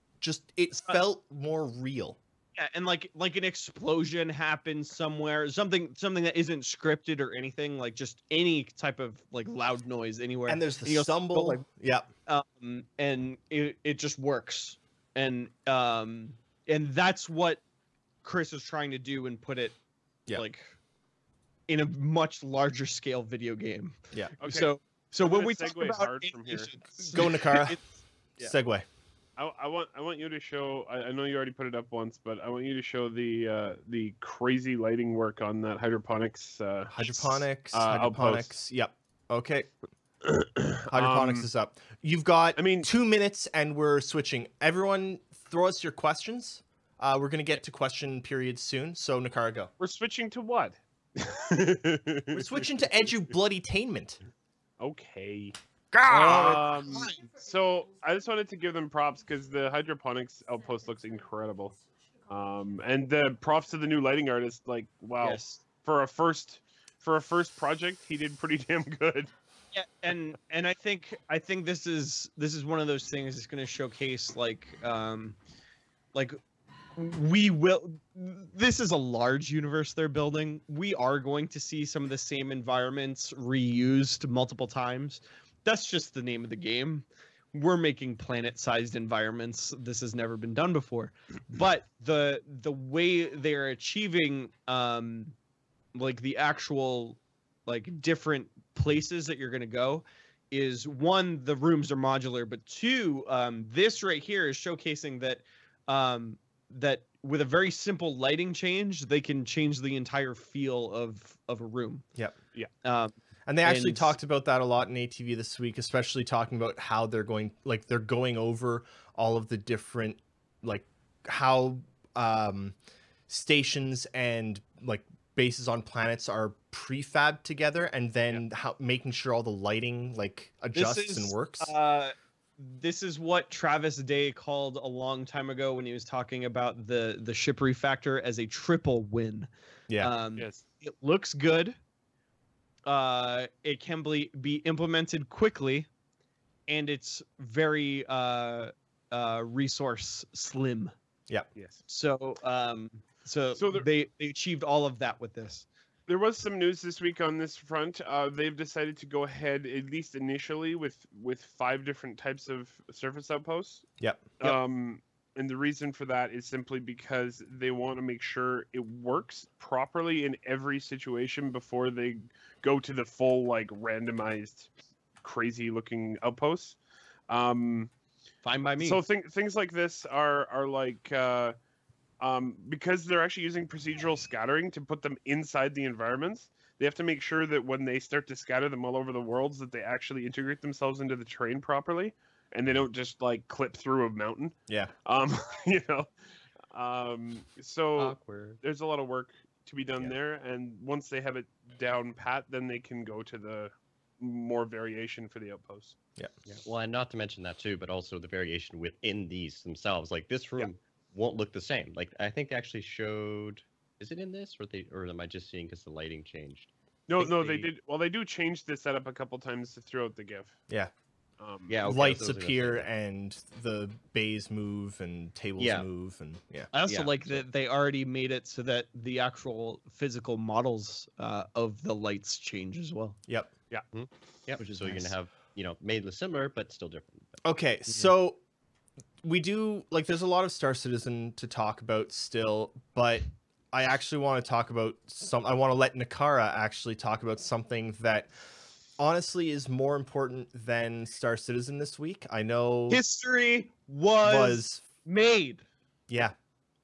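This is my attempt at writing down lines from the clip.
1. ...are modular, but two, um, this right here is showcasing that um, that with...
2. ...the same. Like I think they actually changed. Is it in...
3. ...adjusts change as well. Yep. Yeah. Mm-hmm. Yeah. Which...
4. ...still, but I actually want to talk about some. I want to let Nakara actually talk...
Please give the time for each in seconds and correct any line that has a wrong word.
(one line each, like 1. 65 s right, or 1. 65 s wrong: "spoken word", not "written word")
1. 101 s right
2. 211 s wrong: "showed", not "changed"
3. 231 s wrong: "lights", not "adjusts"
4. 242 s right.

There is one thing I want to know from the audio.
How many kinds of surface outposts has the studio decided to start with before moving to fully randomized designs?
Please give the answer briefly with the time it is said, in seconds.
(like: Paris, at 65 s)
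5, at 161 s.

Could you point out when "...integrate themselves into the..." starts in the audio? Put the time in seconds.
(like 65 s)
190 s.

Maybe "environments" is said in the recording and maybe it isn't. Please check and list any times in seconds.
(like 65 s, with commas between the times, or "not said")
82 s, 88 s, 185 s.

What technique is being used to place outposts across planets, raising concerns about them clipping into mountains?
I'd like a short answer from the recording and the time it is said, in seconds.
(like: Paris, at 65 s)
Procedural scattering, at 183 s.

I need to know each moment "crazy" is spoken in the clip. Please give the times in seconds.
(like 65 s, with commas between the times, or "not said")
34 s, 175 s.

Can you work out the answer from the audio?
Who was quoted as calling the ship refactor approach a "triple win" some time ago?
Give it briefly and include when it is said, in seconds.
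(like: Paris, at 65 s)
Travis Day, at 133 s.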